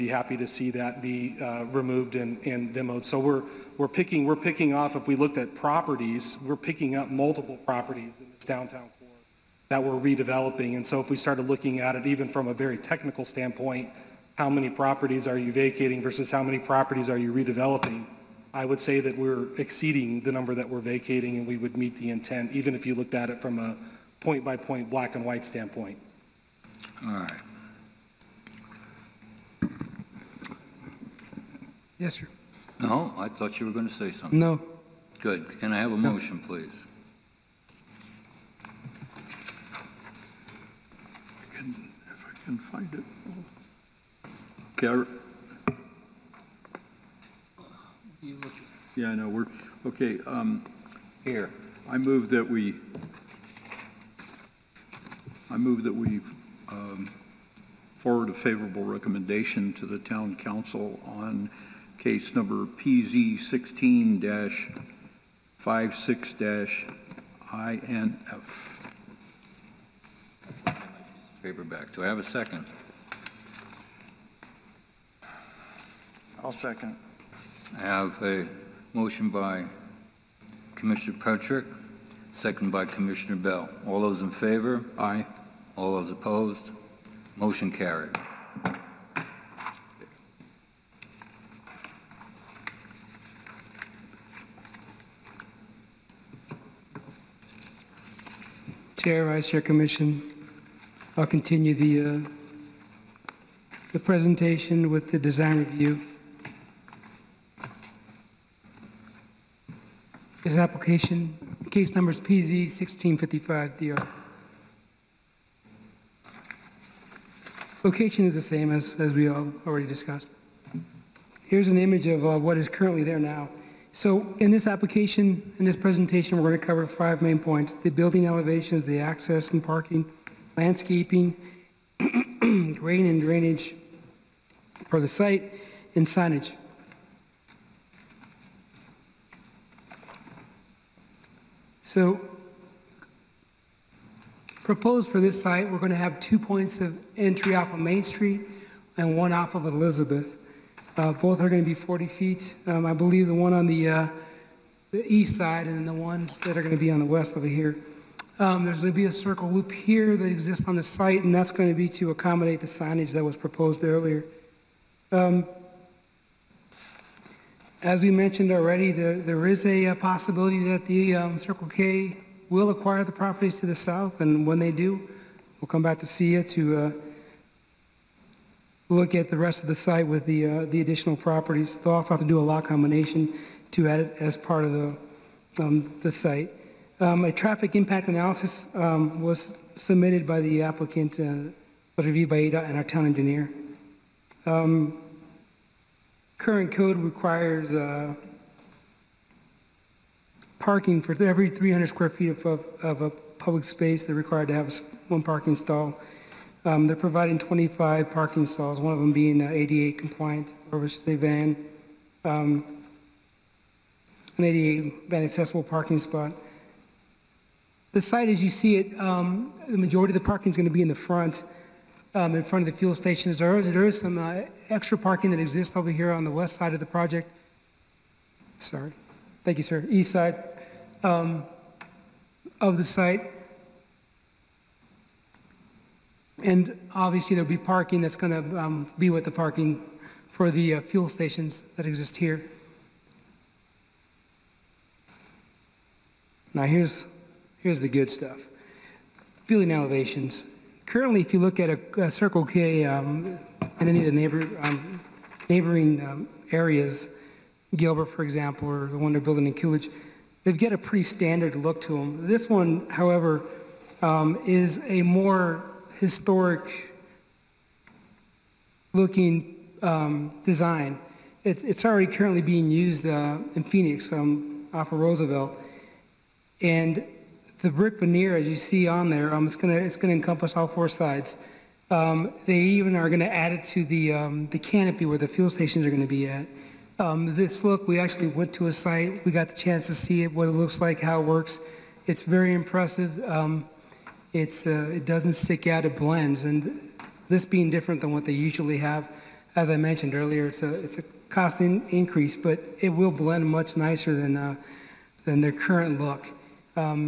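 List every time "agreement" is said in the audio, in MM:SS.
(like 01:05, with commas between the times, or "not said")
not said.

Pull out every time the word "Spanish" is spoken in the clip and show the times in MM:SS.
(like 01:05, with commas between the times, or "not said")
not said.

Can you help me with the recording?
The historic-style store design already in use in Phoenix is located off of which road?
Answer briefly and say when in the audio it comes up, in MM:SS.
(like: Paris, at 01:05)
Roosevelt, at 04:34.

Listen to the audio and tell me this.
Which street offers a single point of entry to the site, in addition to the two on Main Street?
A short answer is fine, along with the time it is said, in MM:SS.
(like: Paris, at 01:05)
Elizabeth, at 02:29.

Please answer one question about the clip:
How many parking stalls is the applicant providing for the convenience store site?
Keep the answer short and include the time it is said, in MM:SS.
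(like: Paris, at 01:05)
25, at 03:27.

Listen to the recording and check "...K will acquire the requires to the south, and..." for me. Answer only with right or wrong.
wrong.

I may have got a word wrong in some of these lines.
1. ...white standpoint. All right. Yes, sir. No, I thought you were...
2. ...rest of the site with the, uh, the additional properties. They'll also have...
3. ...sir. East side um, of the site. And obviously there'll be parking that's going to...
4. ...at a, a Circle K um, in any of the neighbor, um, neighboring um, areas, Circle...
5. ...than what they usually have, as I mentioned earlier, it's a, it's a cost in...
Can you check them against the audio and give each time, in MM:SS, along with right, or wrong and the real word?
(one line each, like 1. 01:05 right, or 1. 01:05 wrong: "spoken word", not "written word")
1. 00:25 right
2. 02:59 right
3. 03:49 right
4. 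04:11 wrong: "Gilbert", not "Circle"
5. 04:58 right.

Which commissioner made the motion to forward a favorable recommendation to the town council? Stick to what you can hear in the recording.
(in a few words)
Petrick.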